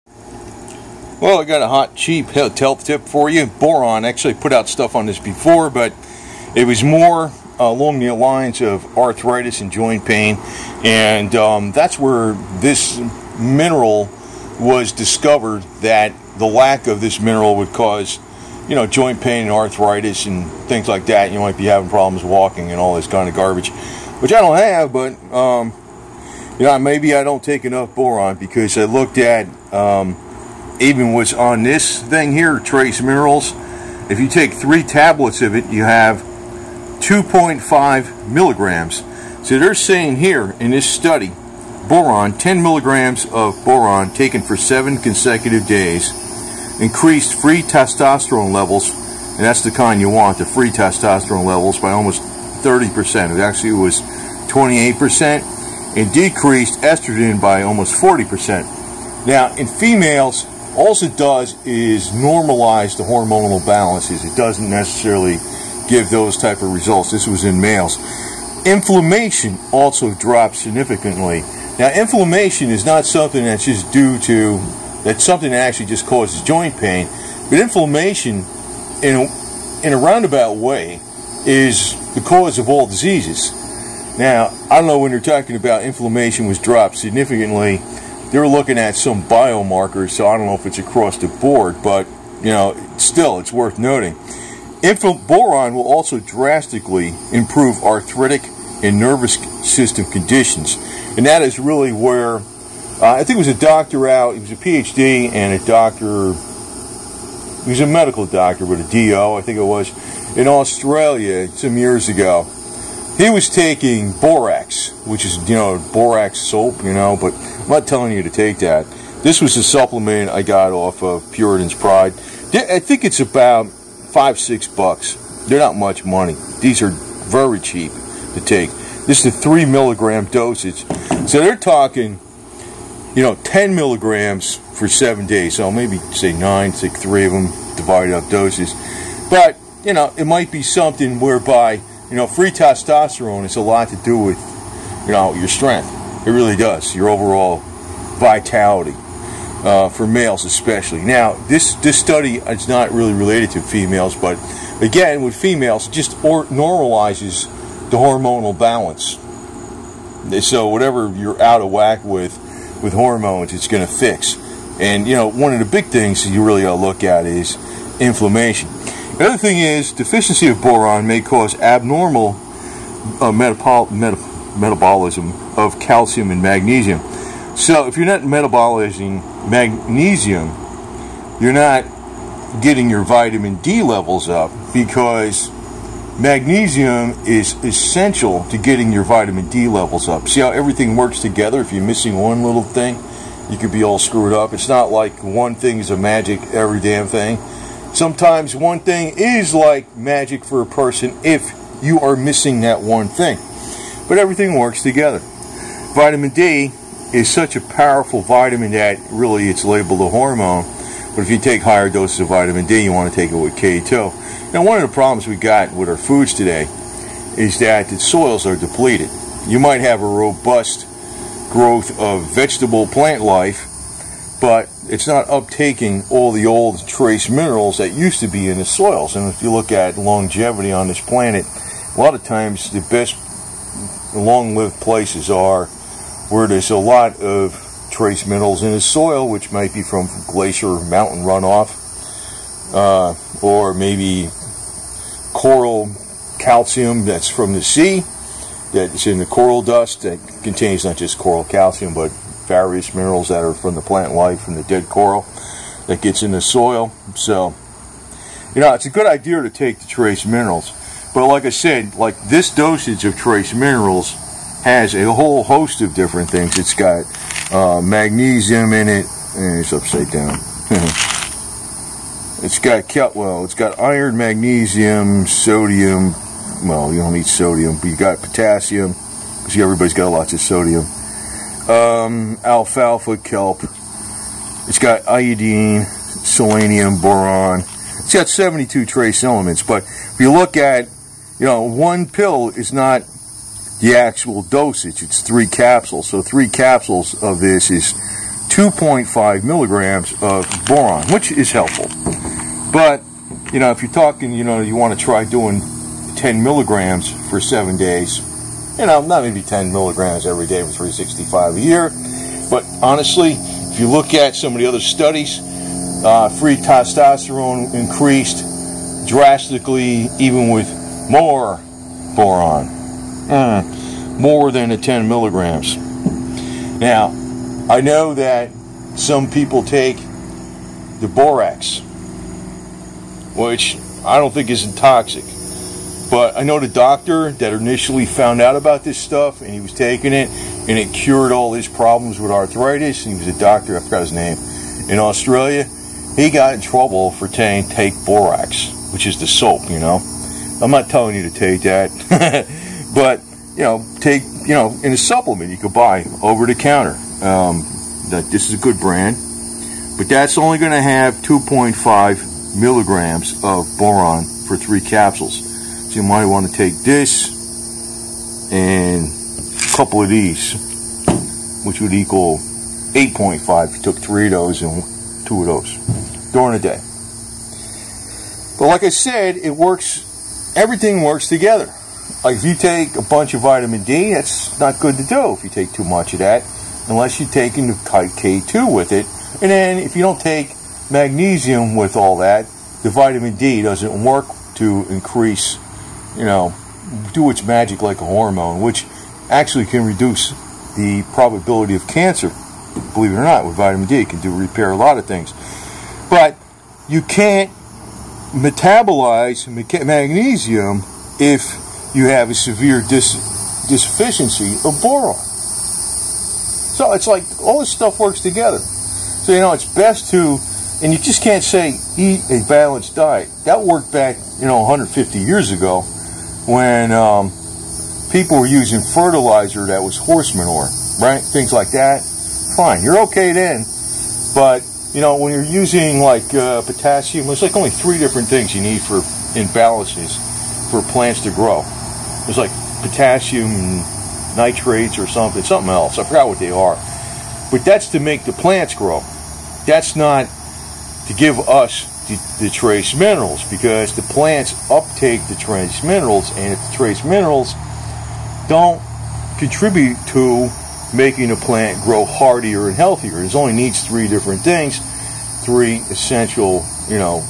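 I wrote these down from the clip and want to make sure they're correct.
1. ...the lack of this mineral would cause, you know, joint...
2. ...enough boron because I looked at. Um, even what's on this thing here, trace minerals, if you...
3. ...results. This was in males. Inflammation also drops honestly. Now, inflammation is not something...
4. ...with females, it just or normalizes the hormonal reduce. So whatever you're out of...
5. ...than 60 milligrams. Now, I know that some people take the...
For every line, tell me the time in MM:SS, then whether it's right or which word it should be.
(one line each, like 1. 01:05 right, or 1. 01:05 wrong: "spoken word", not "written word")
1. 00:16 right
2. 00:27 right
3. 01:06 wrong: "significantly", not "honestly"
4. 02:35 wrong: "balance", not "reduce"
5. 05:24 wrong: "10", not "60".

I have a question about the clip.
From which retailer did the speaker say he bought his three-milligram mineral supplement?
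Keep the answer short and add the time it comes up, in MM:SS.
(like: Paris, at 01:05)
Puritan's Pride, at 02:01.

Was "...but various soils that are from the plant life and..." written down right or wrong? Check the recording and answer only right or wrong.
wrong.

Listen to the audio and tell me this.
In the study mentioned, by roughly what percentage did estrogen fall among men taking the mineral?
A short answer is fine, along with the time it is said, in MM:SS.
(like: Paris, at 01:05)
almost 40%, at 00:57.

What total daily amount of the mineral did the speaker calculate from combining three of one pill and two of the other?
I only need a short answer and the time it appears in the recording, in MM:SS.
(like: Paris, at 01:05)
8.5 mg, at 06:12.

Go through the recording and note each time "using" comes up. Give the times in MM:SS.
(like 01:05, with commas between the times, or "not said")
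07:08, 07:15.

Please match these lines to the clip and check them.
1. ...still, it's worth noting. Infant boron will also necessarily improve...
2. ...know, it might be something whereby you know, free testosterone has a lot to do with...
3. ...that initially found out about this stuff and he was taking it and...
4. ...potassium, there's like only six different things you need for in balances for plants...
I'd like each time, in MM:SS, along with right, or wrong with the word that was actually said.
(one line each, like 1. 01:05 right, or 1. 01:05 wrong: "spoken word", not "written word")
1. 01:32 wrong: "drastically", not "necessarily"
2. 02:19 right
3. 05:37 right
4. 07:16 wrong: "three", not "six".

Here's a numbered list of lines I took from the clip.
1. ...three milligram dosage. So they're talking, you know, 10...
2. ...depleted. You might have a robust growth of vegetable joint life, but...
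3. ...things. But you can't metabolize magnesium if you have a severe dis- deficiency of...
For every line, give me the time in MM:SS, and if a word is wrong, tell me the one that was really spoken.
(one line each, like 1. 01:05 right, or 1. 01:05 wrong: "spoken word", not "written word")
1. 02:09 right
2. 03:38 wrong: "plant", not "joint"
3. 06:45 right.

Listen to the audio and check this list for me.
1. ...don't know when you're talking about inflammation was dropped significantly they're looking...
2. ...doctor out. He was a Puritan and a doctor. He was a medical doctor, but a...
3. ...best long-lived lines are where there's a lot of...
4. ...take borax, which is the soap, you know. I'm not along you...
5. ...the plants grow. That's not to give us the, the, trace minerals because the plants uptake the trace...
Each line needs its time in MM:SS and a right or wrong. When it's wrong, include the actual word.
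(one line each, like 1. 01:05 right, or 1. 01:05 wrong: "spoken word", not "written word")
1. 01:24 right
2. 01:43 wrong: "PhD", not "Puritan"
3. 03:52 wrong: "places", not "lines"
4. 05:47 wrong: "telling", not "along"
5. 07:28 right.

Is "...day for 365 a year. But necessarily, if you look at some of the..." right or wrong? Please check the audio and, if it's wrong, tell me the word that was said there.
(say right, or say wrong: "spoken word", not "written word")
wrong: "honestly", not "necessarily".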